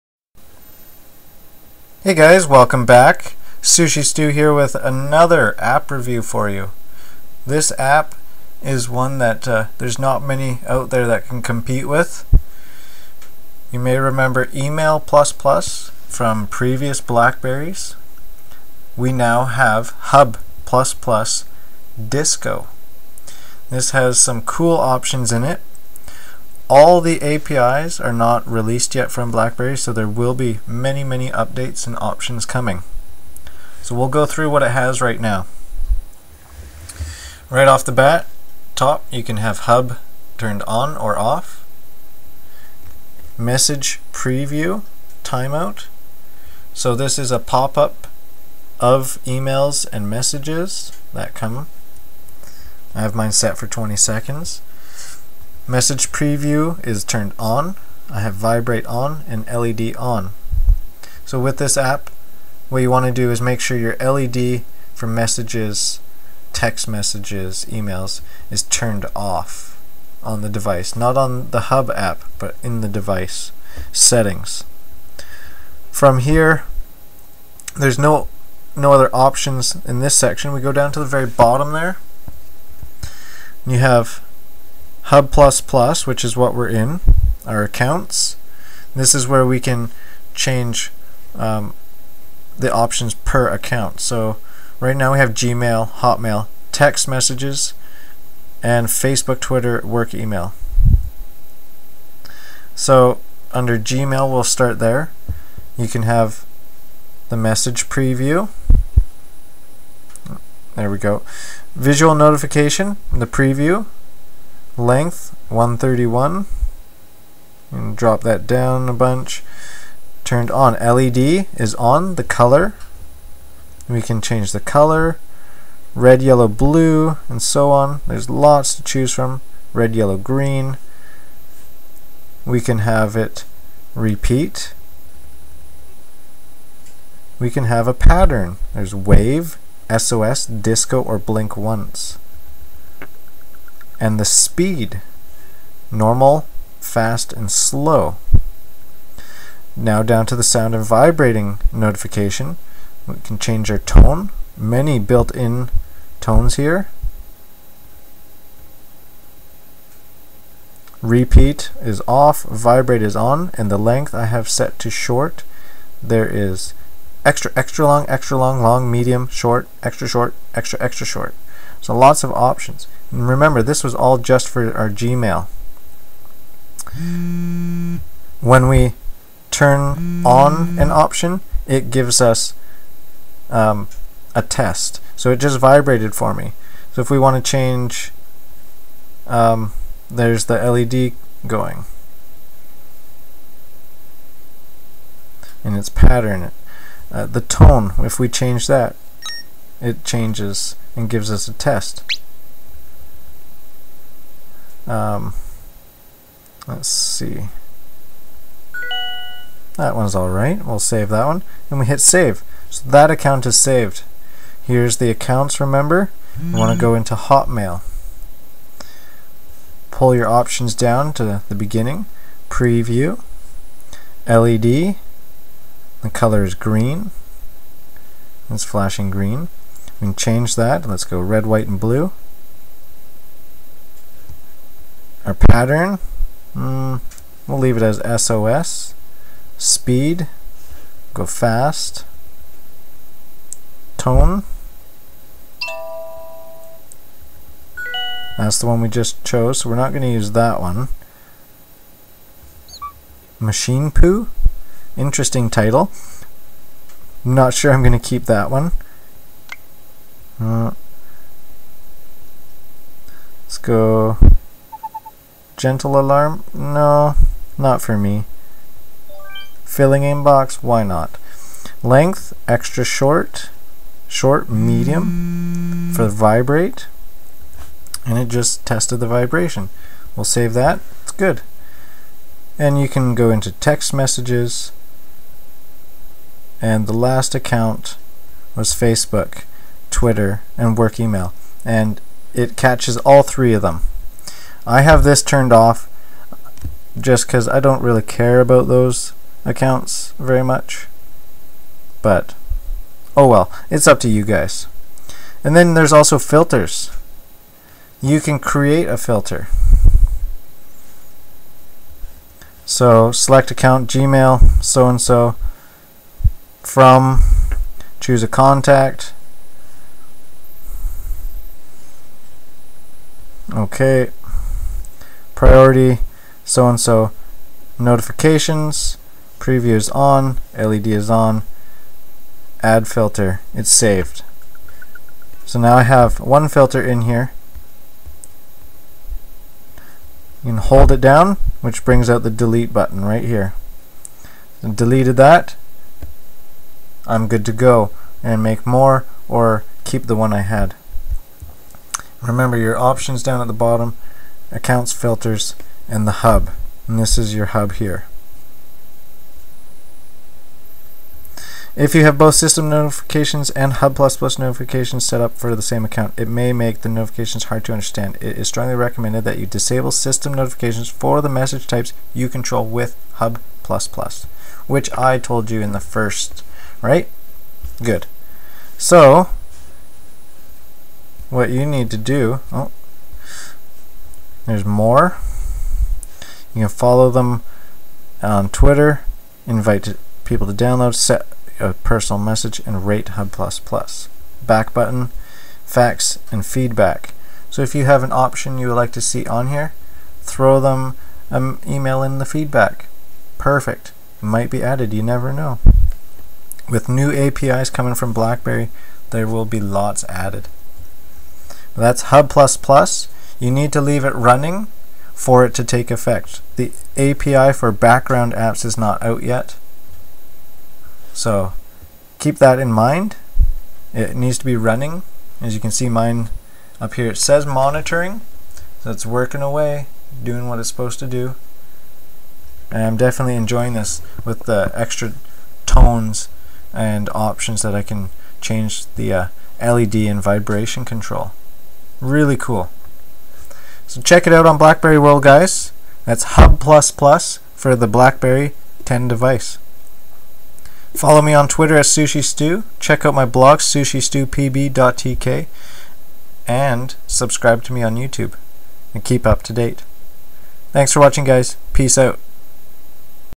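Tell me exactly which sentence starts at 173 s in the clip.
And remember, this was all just for our Gmail.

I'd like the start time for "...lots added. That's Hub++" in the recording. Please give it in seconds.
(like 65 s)
409 s.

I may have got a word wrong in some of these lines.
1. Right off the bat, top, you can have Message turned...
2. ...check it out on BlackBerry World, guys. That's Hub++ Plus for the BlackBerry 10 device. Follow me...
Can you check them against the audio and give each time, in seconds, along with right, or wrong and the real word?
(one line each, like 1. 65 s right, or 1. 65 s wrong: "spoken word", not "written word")
1. 37 s wrong: "Hub", not "Message"
2. 444 s right.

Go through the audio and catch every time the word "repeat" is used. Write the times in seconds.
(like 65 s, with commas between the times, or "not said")
133 s, 161 s.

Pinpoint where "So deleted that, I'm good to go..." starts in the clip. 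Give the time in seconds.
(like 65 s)
344 s.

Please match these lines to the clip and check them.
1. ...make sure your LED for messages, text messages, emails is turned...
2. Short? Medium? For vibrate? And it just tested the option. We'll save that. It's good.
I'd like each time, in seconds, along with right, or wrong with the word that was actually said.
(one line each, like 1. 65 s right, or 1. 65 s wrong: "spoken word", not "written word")
1. 63 s right
2. 274 s wrong: "vibration", not "option".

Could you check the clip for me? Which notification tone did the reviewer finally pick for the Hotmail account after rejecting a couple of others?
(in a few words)
Filling inbox.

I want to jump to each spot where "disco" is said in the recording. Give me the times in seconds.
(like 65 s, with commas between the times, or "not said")
22 s, 140 s.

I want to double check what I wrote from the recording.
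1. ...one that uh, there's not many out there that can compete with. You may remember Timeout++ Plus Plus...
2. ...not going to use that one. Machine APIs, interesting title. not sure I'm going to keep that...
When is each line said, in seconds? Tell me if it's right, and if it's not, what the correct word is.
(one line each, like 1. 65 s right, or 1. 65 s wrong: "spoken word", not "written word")
1. 8 s wrong: "Email", not "Timeout"
2. 249 s wrong: "Poo", not "APIs".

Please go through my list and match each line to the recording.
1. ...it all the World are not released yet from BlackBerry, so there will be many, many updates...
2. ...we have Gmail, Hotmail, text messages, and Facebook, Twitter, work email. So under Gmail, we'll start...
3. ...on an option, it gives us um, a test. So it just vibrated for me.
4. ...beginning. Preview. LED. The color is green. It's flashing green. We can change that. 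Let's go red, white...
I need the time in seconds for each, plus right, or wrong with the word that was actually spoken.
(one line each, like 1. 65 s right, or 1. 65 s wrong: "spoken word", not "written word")
1. 25 s wrong: "APIs", not "World"
2. 95 s right
3. 180 s right
4. 221 s right.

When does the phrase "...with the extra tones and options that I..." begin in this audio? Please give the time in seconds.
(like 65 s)
434 s.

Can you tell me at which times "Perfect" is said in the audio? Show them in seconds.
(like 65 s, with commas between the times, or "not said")
403 s.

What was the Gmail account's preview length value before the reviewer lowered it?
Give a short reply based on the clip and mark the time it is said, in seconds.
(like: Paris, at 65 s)
131, at 115 s.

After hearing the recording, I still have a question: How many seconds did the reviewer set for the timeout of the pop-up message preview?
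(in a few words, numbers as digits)
20.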